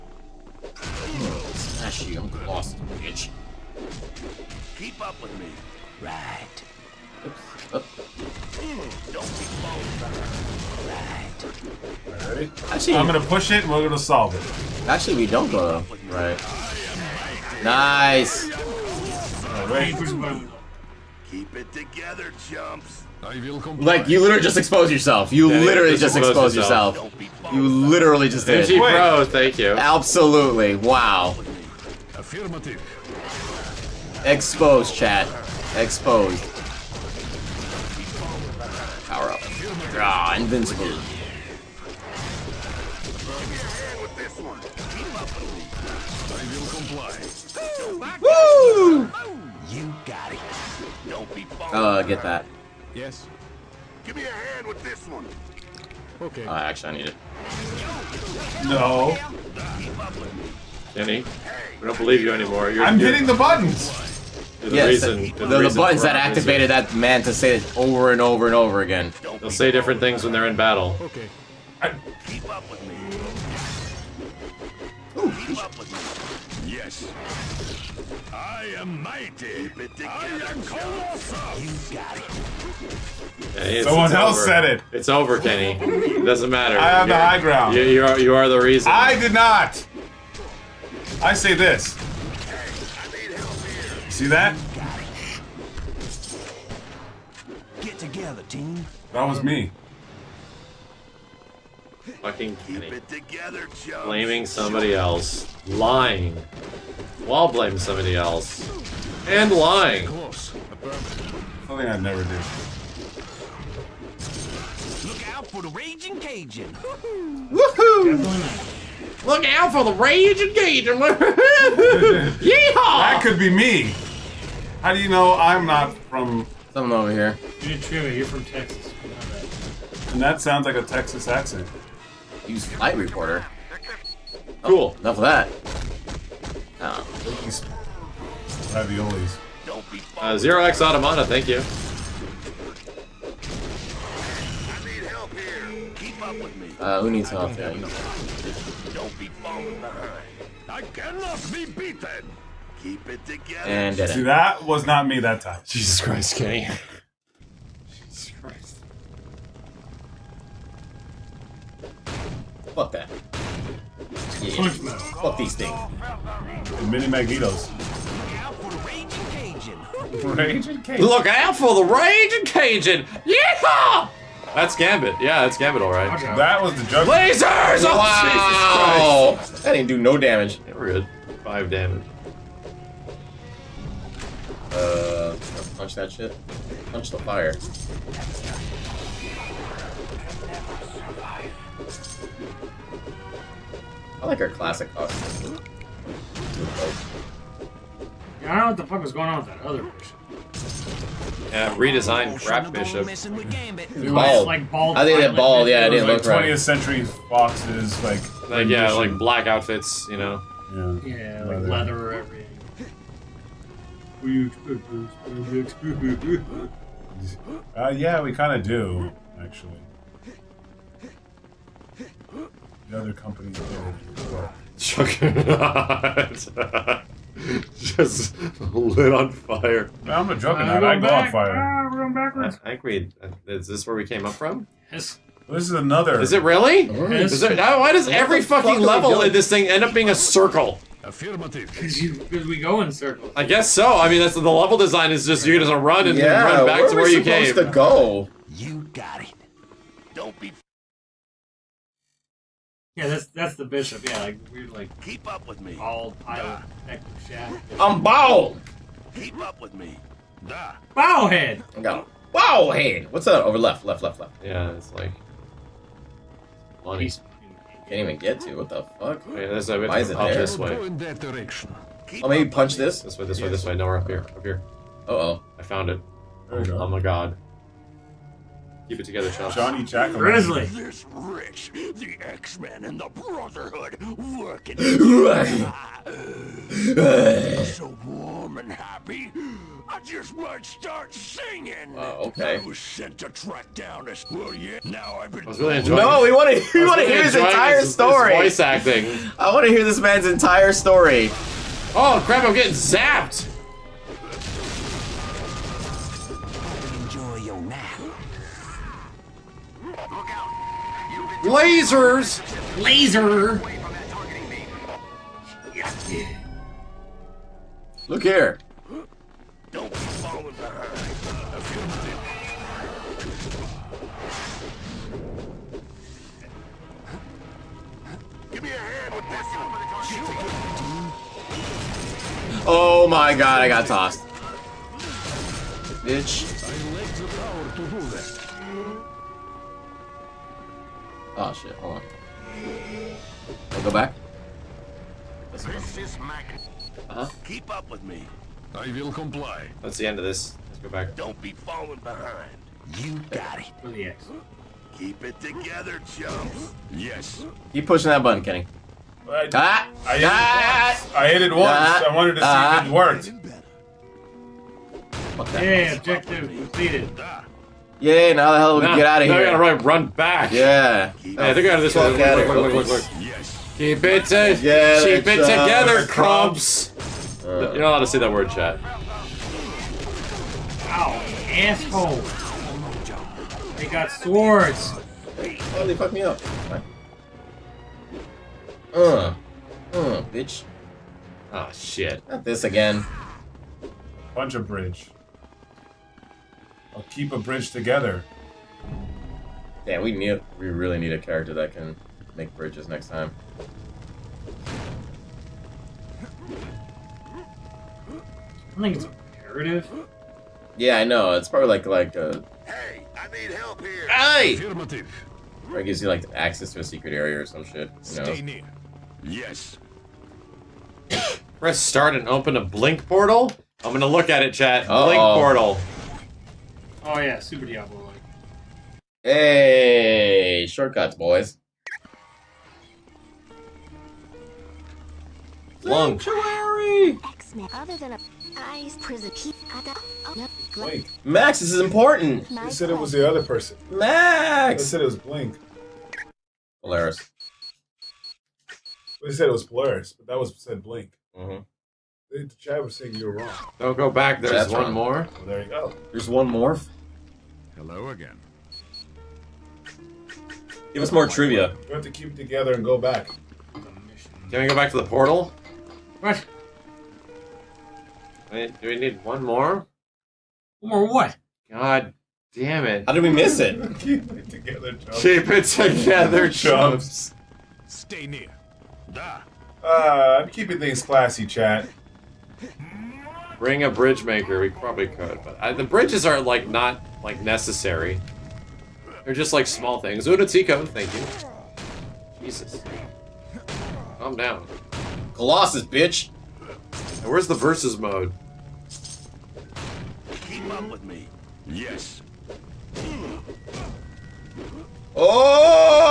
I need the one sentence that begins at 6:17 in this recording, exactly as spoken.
Uh, You're not allowed to say that word, chat.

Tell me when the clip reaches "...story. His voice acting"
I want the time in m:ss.
4:57.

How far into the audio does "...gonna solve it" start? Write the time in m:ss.
0:13.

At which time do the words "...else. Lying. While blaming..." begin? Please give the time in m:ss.
1:44.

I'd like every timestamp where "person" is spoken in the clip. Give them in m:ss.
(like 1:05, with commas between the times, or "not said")
7:23.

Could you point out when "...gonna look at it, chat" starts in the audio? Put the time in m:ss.
7:03.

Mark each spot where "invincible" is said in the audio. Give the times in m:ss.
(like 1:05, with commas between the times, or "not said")
0:40.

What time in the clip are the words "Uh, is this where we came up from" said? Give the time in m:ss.
3:53.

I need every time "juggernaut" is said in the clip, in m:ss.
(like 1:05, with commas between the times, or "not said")
3:44, 3:50.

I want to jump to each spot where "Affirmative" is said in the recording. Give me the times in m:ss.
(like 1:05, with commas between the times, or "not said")
0:32, 6:54.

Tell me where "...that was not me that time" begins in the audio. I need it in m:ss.
2:34.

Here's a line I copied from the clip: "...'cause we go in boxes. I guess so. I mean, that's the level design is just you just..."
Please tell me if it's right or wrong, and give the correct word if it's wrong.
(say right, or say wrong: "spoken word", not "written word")
wrong: "circles", not "boxes".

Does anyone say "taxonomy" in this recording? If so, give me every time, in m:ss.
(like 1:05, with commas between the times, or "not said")
not said.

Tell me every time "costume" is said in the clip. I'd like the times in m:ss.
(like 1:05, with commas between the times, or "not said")
3:14.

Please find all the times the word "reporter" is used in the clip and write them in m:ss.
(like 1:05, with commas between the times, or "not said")
2:12.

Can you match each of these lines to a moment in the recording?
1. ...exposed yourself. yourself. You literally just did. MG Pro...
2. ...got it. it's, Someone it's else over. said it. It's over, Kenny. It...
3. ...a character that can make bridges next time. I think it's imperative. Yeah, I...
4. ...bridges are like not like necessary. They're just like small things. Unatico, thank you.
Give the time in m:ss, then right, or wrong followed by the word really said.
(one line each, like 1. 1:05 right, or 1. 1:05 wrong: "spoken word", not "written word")
1. 0:26 right
2. 1:21 right
3. 6:41 right
4. 8:05 right.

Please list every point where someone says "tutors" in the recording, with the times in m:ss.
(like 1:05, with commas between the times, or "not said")
not said.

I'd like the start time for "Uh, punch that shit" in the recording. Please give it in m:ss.
3:04.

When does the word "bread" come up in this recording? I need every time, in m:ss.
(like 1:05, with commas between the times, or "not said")
not said.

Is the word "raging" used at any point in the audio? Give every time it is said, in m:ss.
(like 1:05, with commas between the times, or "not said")
1:55, 1:59, 2:51.